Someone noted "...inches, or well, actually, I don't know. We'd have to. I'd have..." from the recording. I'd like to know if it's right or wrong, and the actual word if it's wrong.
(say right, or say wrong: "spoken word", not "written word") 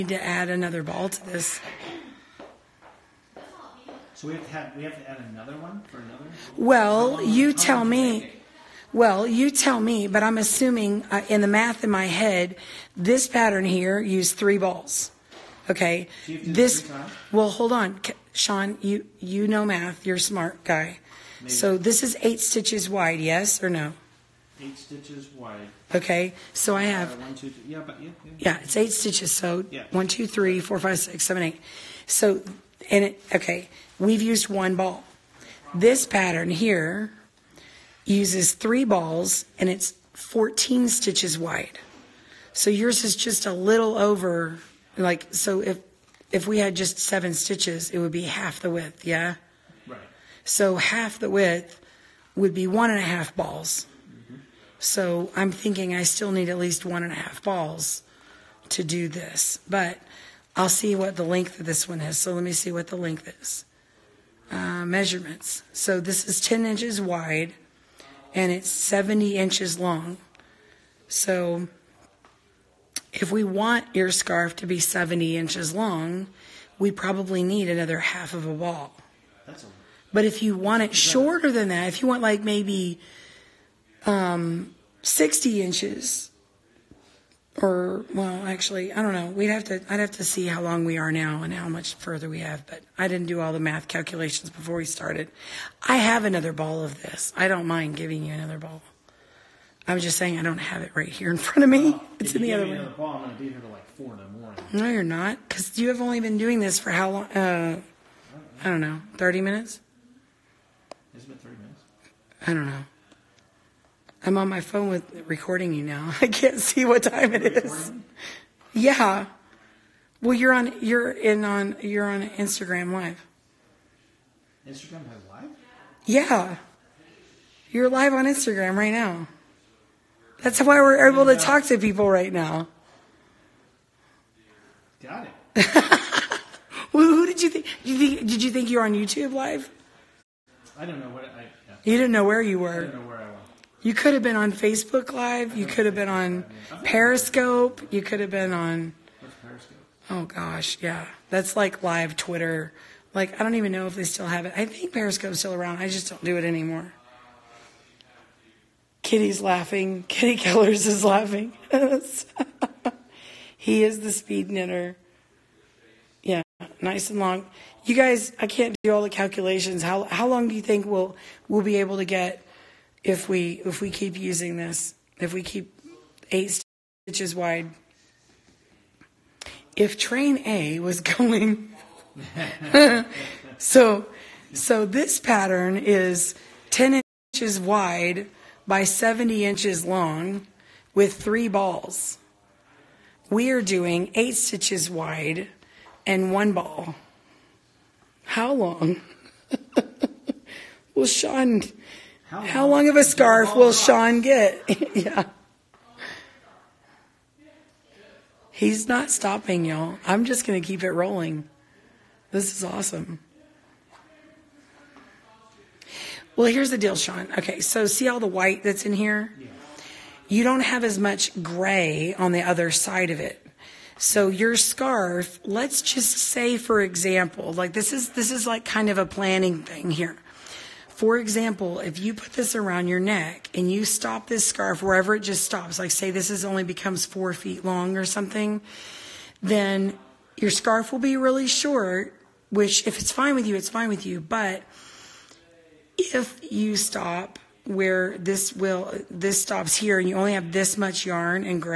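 right.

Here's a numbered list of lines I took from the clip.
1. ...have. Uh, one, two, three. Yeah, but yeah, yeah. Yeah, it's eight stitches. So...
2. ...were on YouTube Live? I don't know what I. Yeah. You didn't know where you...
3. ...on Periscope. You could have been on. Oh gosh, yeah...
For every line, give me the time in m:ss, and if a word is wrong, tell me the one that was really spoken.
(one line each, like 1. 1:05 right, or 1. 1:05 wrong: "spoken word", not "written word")
1. 0:26 right
2. 2:18 right
3. 2:26 right.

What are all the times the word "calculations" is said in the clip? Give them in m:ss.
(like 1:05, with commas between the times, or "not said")
1:33, 2:49.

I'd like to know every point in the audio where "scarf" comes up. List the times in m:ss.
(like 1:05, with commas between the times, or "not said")
1:14, 3:23, 3:44, 3:54, 4:00.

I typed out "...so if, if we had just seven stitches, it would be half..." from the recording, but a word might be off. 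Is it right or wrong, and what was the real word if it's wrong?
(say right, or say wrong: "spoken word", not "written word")
right.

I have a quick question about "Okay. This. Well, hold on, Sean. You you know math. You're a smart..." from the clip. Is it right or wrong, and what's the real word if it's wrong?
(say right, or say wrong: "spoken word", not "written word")
right.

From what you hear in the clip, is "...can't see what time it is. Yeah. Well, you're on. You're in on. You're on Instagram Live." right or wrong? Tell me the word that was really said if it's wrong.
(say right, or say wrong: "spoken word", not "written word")
right.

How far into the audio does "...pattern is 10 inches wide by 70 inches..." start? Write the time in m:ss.
3:05.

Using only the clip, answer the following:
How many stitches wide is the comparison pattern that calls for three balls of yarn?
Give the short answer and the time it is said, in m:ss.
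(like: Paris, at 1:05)
14, at 0:40.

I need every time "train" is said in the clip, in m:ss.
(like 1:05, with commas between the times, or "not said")
2:59.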